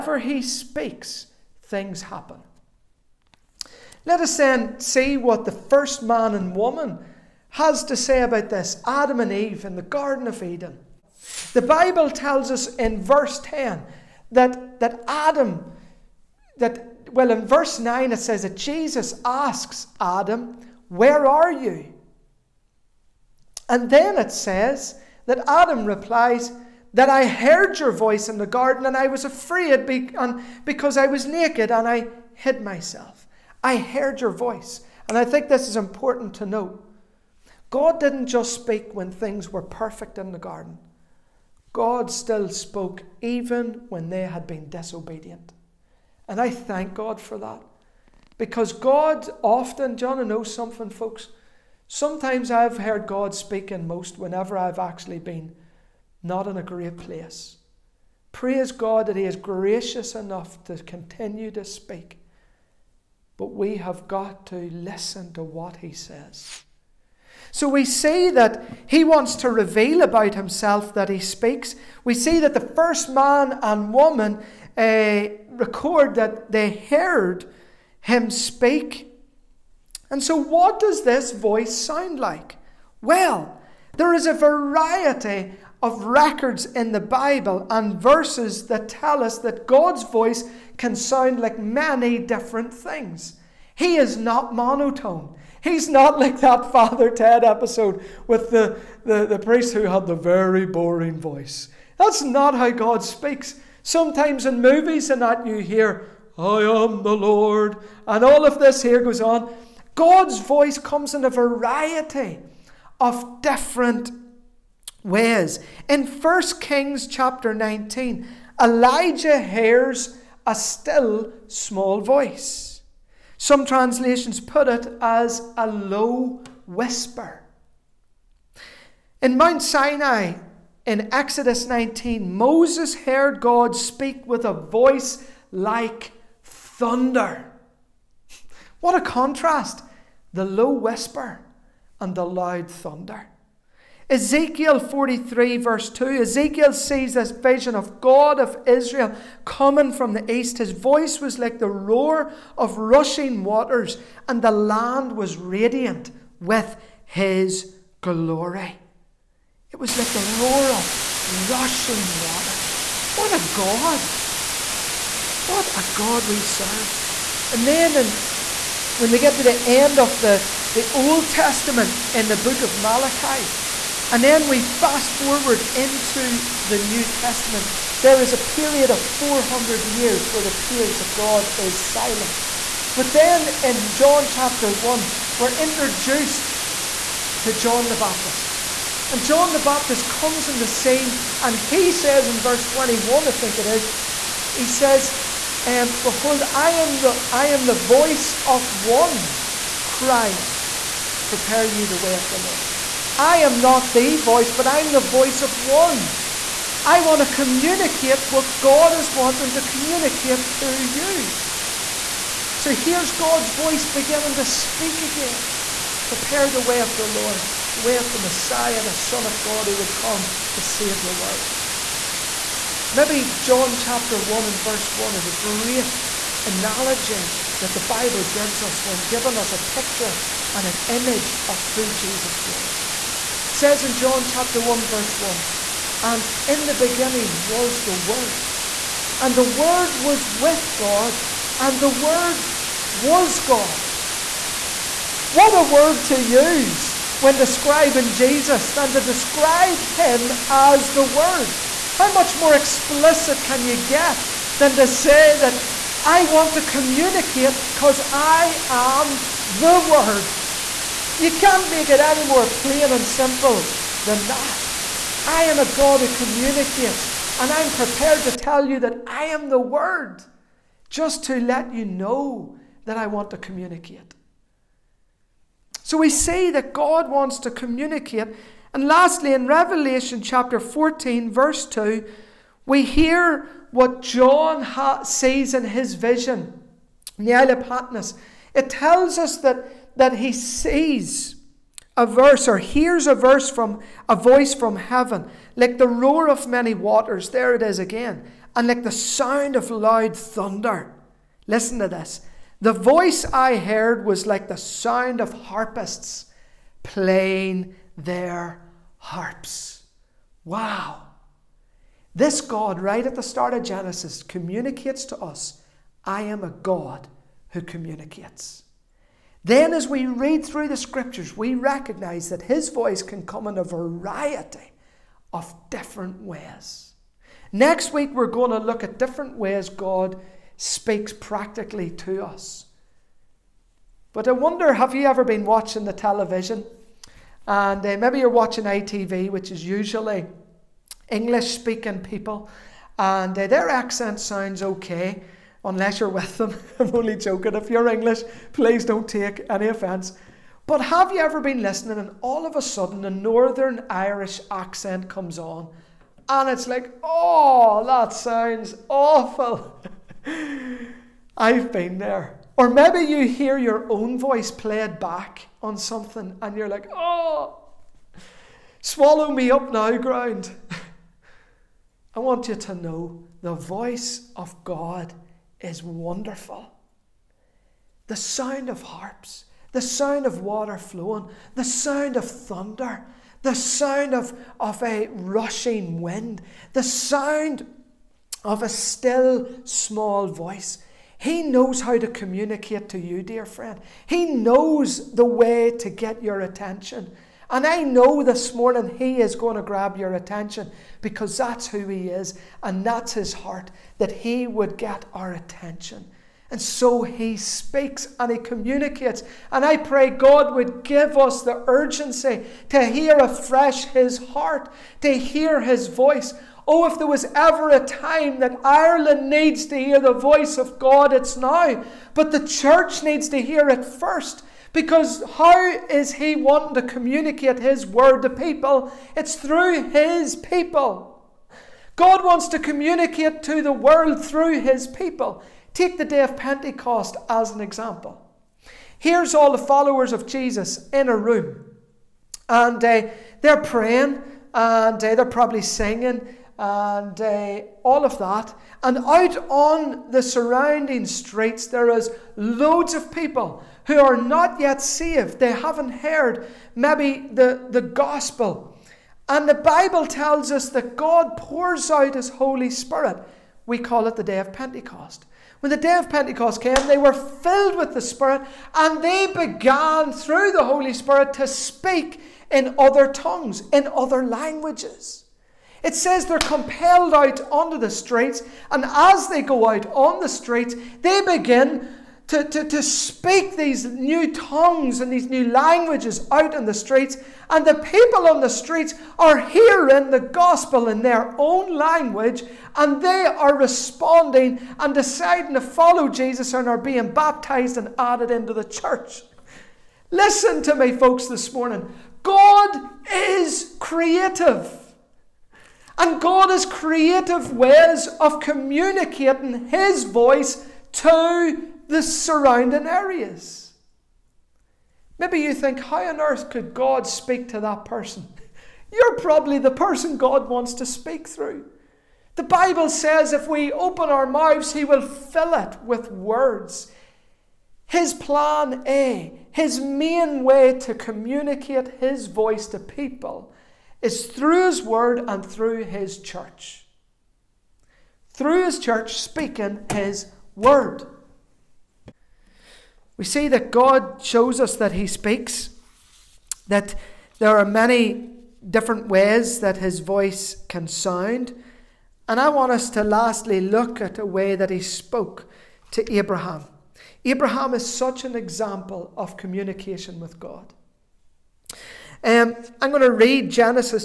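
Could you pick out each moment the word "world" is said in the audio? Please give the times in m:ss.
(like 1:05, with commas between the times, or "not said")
3:41, 7:13.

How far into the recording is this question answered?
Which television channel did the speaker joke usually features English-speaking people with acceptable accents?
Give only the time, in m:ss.
5:38.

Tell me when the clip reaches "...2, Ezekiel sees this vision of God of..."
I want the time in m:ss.
2:25.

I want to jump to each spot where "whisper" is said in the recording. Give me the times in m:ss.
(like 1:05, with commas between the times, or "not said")
2:06, 2:20.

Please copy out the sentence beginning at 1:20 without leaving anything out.
And so, what does this voice sound like?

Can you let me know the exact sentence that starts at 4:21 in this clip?
You can't make it any more plain and simple than that.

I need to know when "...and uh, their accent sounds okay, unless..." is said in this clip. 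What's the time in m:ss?
5:42.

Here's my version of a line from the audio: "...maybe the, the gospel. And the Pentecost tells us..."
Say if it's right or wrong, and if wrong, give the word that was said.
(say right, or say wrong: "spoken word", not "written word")
wrong: "Bible", not "Pentecost".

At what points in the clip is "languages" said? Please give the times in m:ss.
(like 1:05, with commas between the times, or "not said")
7:54, 8:05, 8:11.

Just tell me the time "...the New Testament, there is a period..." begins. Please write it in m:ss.
2:56.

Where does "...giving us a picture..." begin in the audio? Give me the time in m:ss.
3:49.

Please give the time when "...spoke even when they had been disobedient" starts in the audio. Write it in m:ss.
0:42.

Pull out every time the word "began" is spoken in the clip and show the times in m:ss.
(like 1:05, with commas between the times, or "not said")
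7:49.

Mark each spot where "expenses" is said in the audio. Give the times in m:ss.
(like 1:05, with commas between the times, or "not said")
not said.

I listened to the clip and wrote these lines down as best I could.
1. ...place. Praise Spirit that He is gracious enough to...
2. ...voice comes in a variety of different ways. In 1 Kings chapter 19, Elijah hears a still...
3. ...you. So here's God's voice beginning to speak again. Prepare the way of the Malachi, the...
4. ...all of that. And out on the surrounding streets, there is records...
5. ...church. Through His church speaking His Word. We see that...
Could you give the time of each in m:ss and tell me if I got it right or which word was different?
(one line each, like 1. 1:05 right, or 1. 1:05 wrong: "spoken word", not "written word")
1. 0:56 wrong: "God", not "Spirit"
2. 1:50 right
3. 3:30 wrong: "Lord", not "Malachi"
4. 7:27 wrong: "loads", not "records"
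5. 8:56 right.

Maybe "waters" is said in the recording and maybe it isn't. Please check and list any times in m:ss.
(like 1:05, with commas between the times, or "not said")
2:33, 2:42, 4:56, 6:20.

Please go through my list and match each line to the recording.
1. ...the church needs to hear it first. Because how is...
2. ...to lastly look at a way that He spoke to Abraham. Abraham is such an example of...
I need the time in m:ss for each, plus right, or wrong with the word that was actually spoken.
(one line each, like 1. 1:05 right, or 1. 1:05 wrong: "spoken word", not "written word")
1. 7:02 right
2. 9:12 right.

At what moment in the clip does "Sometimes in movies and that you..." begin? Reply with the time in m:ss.
1:43.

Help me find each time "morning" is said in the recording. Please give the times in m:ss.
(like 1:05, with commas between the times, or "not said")
6:38, 8:21.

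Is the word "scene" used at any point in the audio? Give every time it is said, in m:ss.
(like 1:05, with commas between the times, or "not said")
3:10.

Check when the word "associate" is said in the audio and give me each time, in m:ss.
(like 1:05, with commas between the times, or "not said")
not said.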